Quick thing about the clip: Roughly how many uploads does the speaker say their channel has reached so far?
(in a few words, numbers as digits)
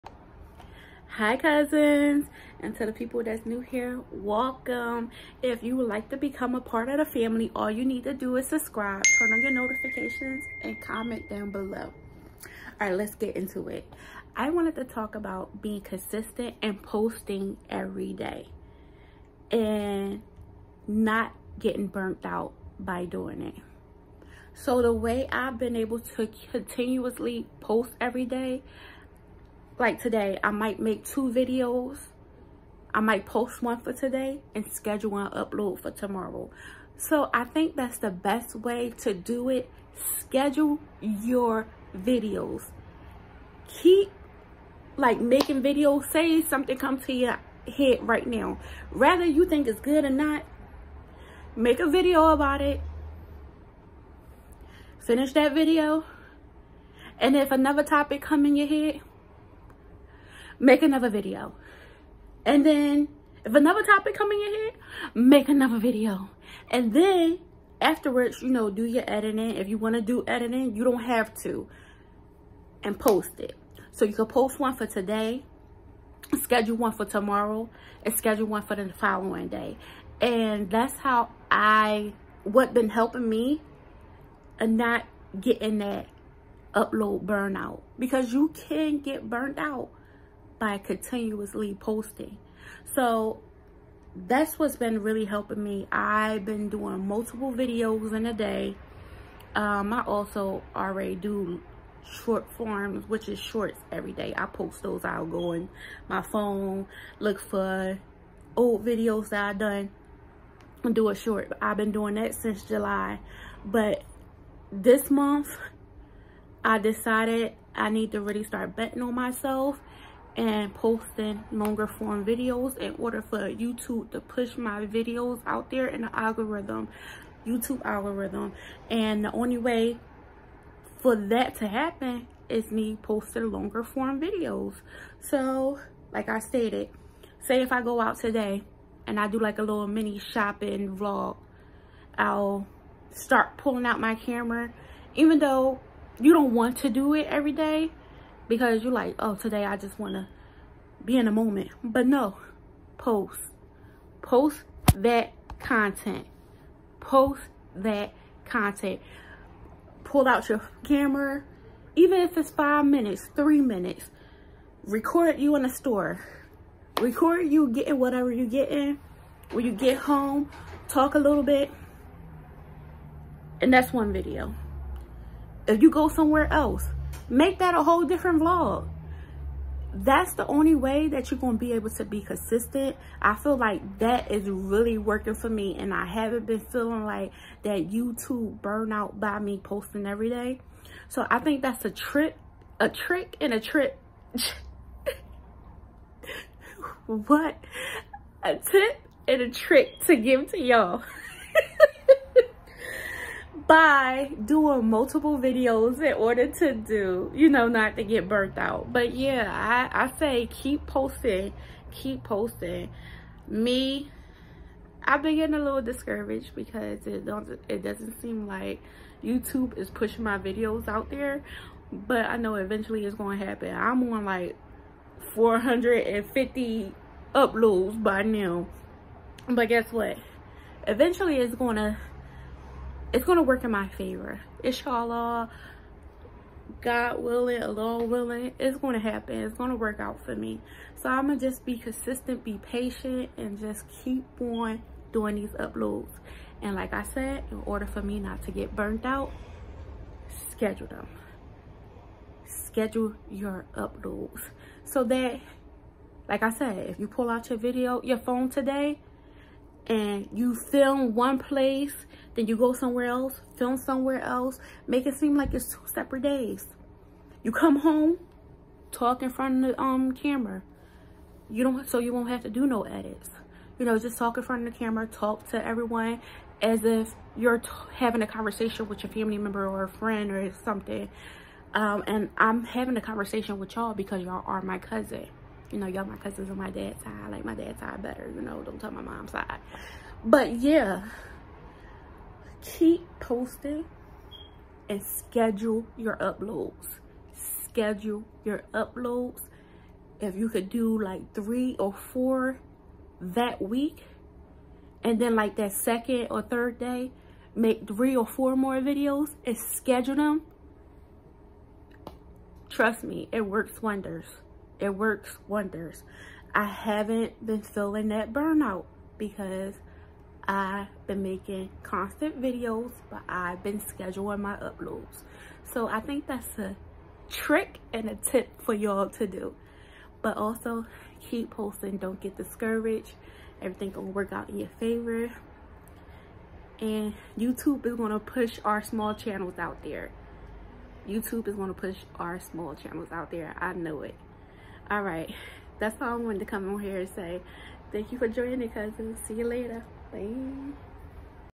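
450.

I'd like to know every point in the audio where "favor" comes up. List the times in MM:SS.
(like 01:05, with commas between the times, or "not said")
03:53, 05:34.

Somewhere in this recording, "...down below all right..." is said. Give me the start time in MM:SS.
00:11.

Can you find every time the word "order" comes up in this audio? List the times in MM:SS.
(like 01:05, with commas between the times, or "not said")
02:02, 03:26, 04:07.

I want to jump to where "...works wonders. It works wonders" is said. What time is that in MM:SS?
05:13.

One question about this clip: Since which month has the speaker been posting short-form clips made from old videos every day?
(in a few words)
July.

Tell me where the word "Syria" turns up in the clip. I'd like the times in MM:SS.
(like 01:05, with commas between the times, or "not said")
not said.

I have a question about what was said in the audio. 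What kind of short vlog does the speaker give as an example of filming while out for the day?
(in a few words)
mini shopping vlog.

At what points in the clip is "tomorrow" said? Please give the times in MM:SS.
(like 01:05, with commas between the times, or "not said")
00:35, 01:17.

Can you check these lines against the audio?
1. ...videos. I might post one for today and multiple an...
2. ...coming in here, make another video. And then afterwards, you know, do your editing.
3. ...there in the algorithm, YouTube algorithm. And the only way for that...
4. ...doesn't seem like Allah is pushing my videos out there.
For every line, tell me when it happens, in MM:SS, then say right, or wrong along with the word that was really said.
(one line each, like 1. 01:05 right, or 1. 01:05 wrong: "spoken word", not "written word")
1. 00:31 wrong: "schedule", not "multiple"
2. 01:04 right
3. 02:05 right
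4. 03:37 wrong: "YouTube", not "Allah".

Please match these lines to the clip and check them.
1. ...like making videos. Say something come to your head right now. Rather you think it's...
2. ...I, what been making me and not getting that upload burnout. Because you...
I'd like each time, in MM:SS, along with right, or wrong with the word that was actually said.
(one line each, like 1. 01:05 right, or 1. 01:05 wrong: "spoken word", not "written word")
1. 00:44 right
2. 01:21 wrong: "helping", not "making".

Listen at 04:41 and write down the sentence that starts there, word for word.
Um, and I'm having a conversation with y'all because y'all are my cousin.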